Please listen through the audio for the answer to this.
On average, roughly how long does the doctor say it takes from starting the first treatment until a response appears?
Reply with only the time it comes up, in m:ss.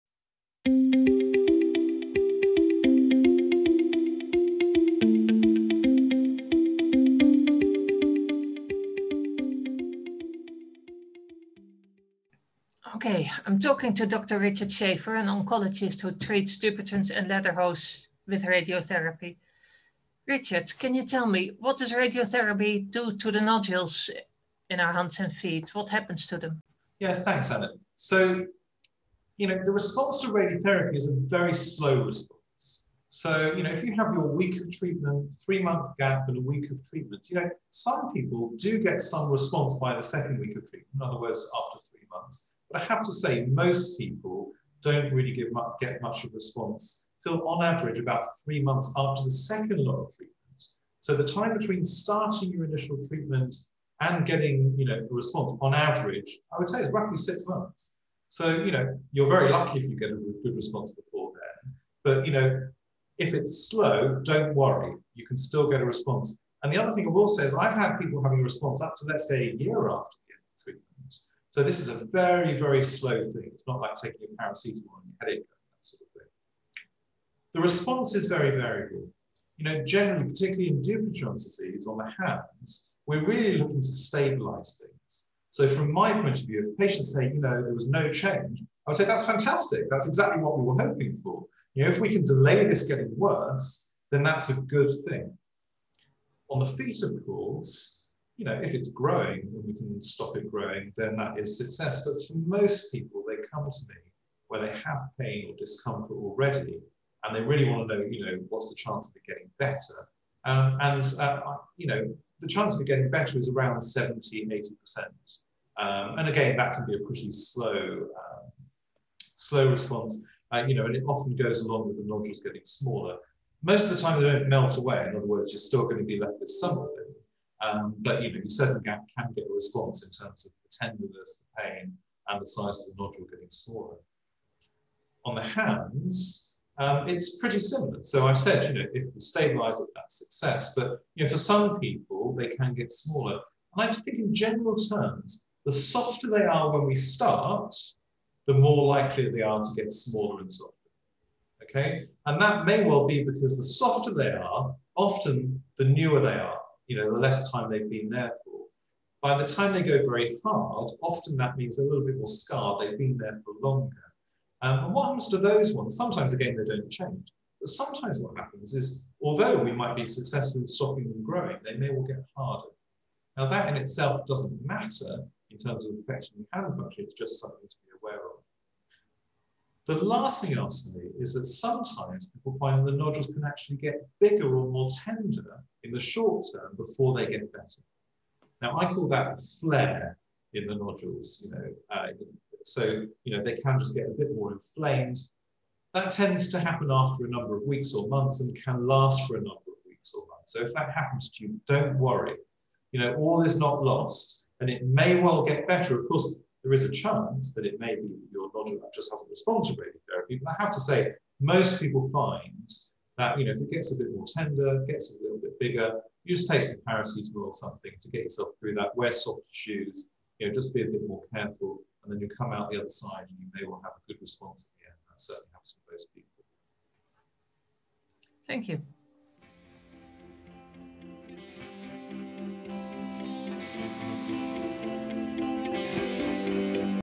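0:57.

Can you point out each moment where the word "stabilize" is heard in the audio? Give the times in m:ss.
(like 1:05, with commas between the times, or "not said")
1:23, 2:19.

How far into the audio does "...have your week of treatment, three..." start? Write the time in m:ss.
0:33.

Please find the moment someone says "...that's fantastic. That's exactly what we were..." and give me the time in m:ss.
1:29.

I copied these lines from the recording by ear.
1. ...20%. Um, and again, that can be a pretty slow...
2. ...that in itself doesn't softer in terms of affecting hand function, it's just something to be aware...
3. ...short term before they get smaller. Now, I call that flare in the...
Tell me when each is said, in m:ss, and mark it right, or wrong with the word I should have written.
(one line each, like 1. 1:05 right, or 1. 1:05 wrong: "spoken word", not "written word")
1. 1:54 wrong: "80", not "20"
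2. 2:53 wrong: "matter", not "softer"
3. 3:05 wrong: "better", not "smaller".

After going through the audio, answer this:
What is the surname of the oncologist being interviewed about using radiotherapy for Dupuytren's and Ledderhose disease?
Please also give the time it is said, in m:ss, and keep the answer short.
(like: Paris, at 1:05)
Shaffer, at 0:14.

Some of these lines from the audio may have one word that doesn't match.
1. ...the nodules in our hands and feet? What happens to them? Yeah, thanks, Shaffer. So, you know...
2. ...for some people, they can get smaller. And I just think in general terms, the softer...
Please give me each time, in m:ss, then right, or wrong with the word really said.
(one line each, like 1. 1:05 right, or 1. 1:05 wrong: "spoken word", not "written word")
1. 0:23 wrong: "Anna", not "Shaffer"
2. 2:21 right.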